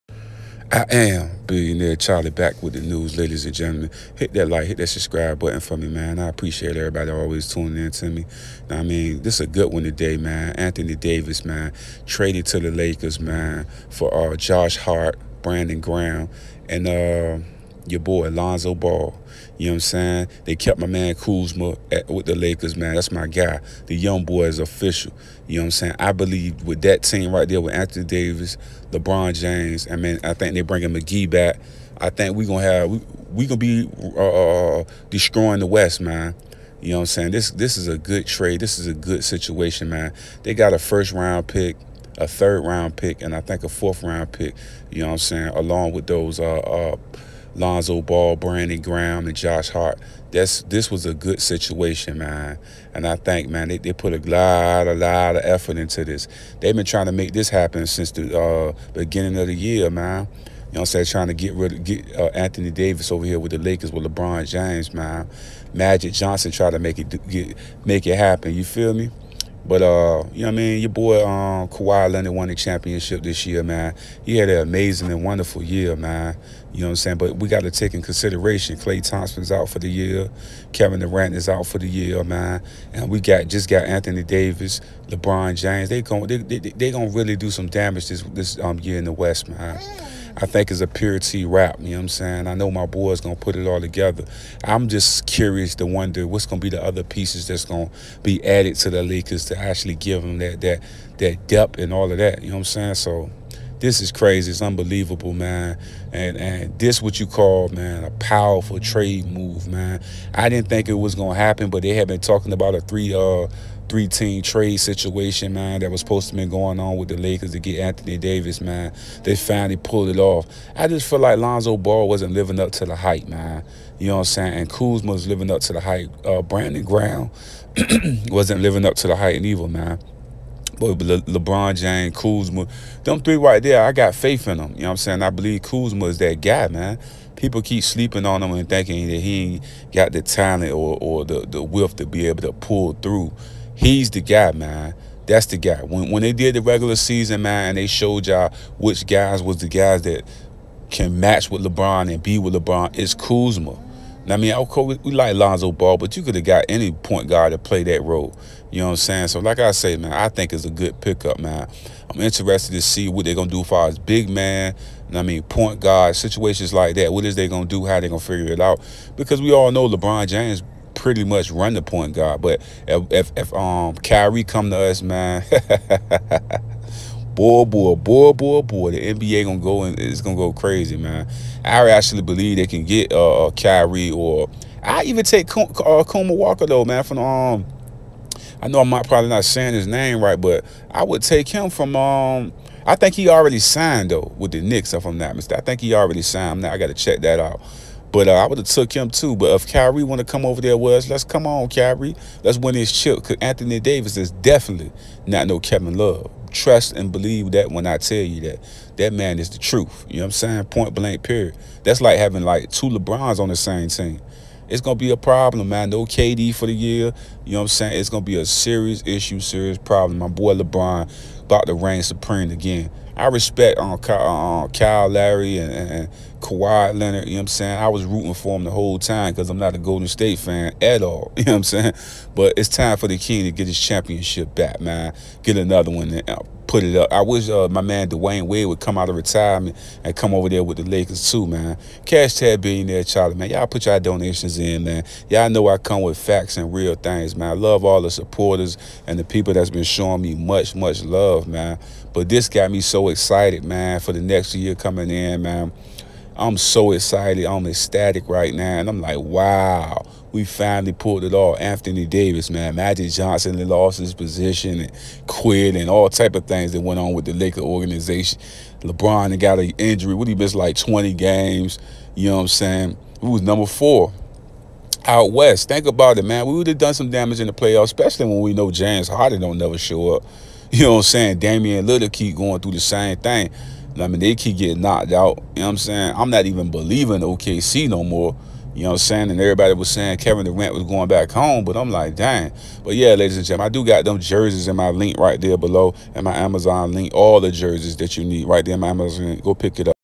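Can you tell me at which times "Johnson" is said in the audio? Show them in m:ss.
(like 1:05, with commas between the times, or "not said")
1:06, 4:23.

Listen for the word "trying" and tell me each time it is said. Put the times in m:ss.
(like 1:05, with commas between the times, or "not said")
0:56, 1:01.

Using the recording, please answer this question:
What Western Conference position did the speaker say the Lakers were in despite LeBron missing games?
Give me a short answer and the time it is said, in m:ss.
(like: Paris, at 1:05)
Number 4, at 4:33.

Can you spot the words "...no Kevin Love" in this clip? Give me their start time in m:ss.
3:25.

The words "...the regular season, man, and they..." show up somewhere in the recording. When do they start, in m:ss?
2:26.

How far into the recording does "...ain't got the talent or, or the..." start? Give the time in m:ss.
2:19.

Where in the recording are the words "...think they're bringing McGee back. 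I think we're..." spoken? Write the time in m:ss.
0:30.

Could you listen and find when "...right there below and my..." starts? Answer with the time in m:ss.
4:55.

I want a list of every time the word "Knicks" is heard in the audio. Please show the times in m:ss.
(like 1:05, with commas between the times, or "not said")
3:14.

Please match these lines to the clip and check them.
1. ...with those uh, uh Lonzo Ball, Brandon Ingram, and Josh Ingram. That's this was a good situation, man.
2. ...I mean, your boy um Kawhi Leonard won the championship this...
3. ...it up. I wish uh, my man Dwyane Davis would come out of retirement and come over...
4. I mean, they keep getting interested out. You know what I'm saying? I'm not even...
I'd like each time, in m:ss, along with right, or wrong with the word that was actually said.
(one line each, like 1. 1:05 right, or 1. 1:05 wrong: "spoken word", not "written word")
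1. 0:45 wrong: "Hart", not "Ingram"
2. 1:10 right
3. 3:56 wrong: "Wade", not "Davis"
4. 4:43 wrong: "knocked", not "interested".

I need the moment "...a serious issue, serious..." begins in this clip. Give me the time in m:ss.
3:38.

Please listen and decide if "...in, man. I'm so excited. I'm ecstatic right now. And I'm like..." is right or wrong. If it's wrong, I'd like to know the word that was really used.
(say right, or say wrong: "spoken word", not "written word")
right.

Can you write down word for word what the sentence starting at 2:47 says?
How they going to figure it out?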